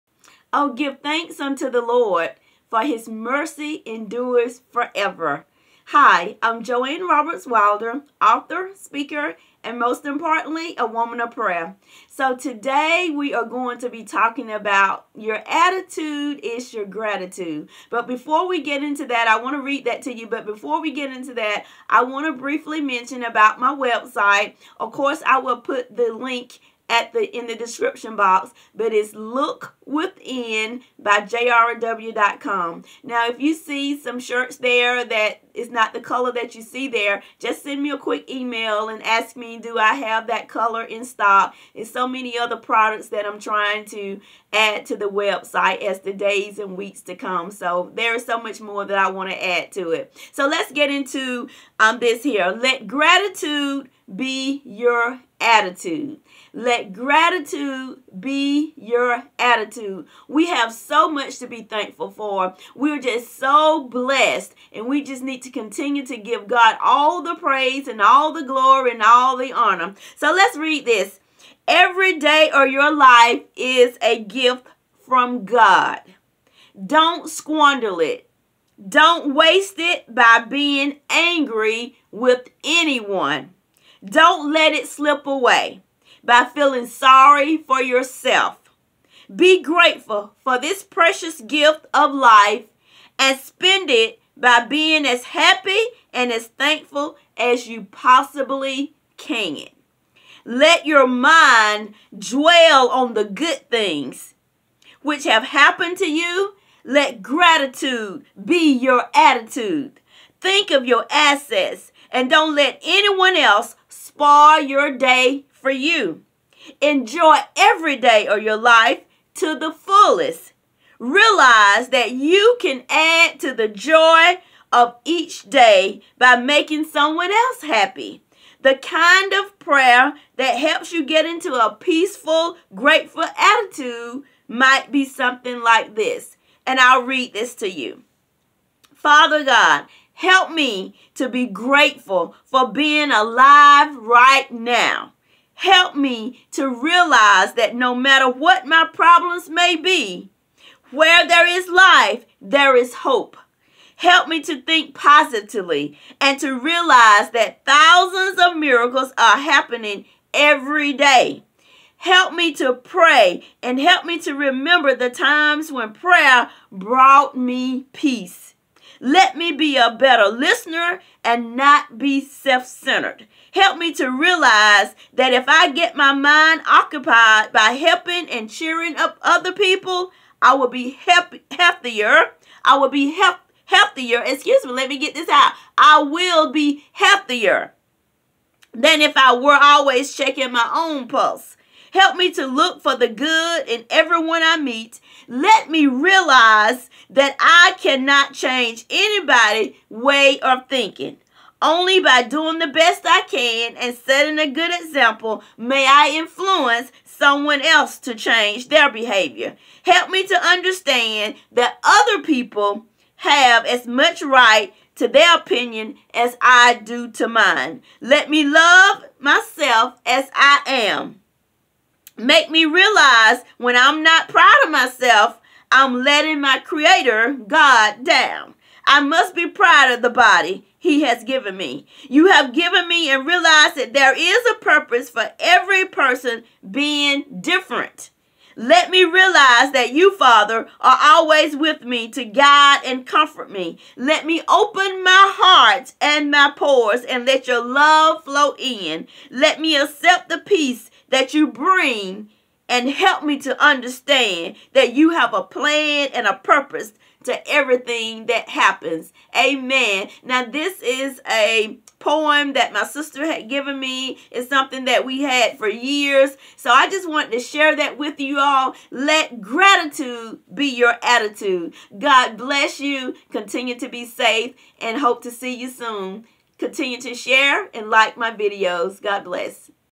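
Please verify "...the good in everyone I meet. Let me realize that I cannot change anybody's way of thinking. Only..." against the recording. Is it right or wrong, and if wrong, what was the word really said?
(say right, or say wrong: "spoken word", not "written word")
right.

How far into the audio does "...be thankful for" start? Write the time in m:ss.
1:01.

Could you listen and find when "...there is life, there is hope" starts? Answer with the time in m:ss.
2:31.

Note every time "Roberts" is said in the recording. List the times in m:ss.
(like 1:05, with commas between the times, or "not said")
0:07.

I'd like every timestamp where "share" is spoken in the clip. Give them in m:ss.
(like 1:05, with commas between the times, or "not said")
4:27, 4:37.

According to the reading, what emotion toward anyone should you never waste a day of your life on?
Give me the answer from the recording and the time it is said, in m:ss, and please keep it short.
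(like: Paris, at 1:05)
Angry, at 1:21.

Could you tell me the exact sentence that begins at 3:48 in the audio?
I must be proud of the body he has given me.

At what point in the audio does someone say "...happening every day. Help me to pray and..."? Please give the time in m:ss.
2:39.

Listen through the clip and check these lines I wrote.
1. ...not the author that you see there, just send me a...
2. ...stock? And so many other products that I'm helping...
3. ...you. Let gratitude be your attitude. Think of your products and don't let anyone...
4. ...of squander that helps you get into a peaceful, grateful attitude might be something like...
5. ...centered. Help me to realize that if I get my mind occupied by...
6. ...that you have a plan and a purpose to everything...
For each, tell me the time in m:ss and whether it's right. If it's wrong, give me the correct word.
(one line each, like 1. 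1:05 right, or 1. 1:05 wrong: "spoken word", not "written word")
1. 0:35 wrong: "color", not "author"
2. 0:41 wrong: "trying", not "helping"
3. 1:46 wrong: "assets", not "products"
4. 2:09 wrong: "prayer", not "squander"
5. 2:52 right
6. 4:14 right.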